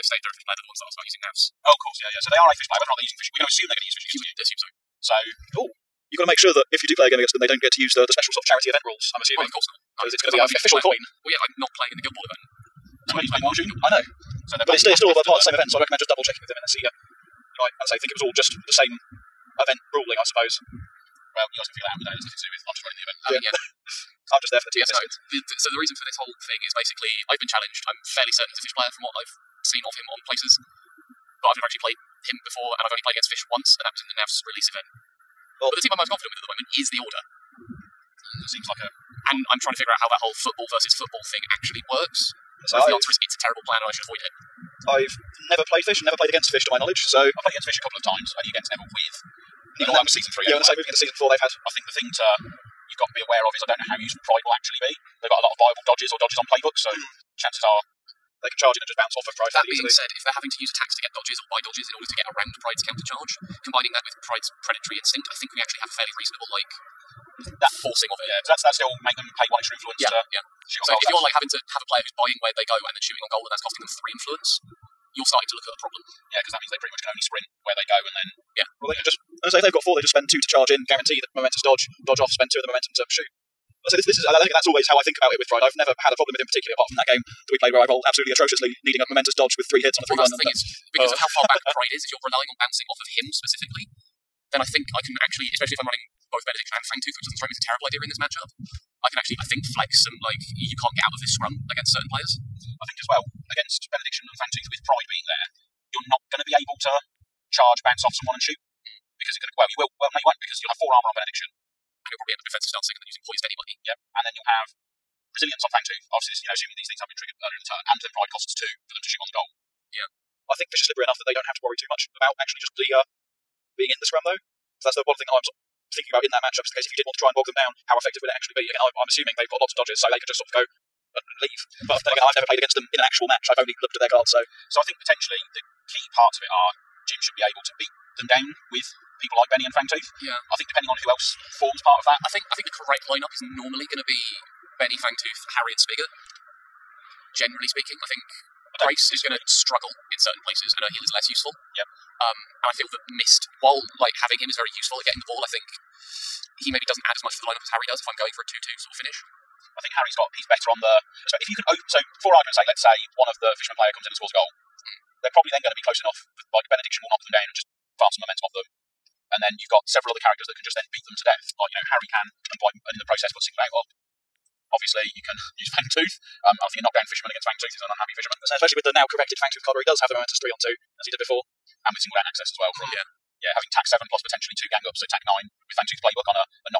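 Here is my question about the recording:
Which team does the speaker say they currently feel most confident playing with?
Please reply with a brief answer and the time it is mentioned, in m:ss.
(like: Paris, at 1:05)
The Order, at 0:36.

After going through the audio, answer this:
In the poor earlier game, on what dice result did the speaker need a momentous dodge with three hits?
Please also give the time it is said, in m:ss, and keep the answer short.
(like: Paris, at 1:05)
3-1, at 1:30.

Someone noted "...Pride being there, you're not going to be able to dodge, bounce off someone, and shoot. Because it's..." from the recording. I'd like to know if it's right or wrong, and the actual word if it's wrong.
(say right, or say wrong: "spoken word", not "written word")
wrong: "charge", not "dodge".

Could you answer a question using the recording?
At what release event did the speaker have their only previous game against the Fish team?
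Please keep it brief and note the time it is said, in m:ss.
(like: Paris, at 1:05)
Navs release event, at 0:34.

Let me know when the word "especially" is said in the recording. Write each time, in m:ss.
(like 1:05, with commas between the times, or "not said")
1:35, 2:58.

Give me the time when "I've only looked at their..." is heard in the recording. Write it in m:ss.
2:13.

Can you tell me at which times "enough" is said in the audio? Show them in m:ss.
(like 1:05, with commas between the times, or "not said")
2:01, 2:46.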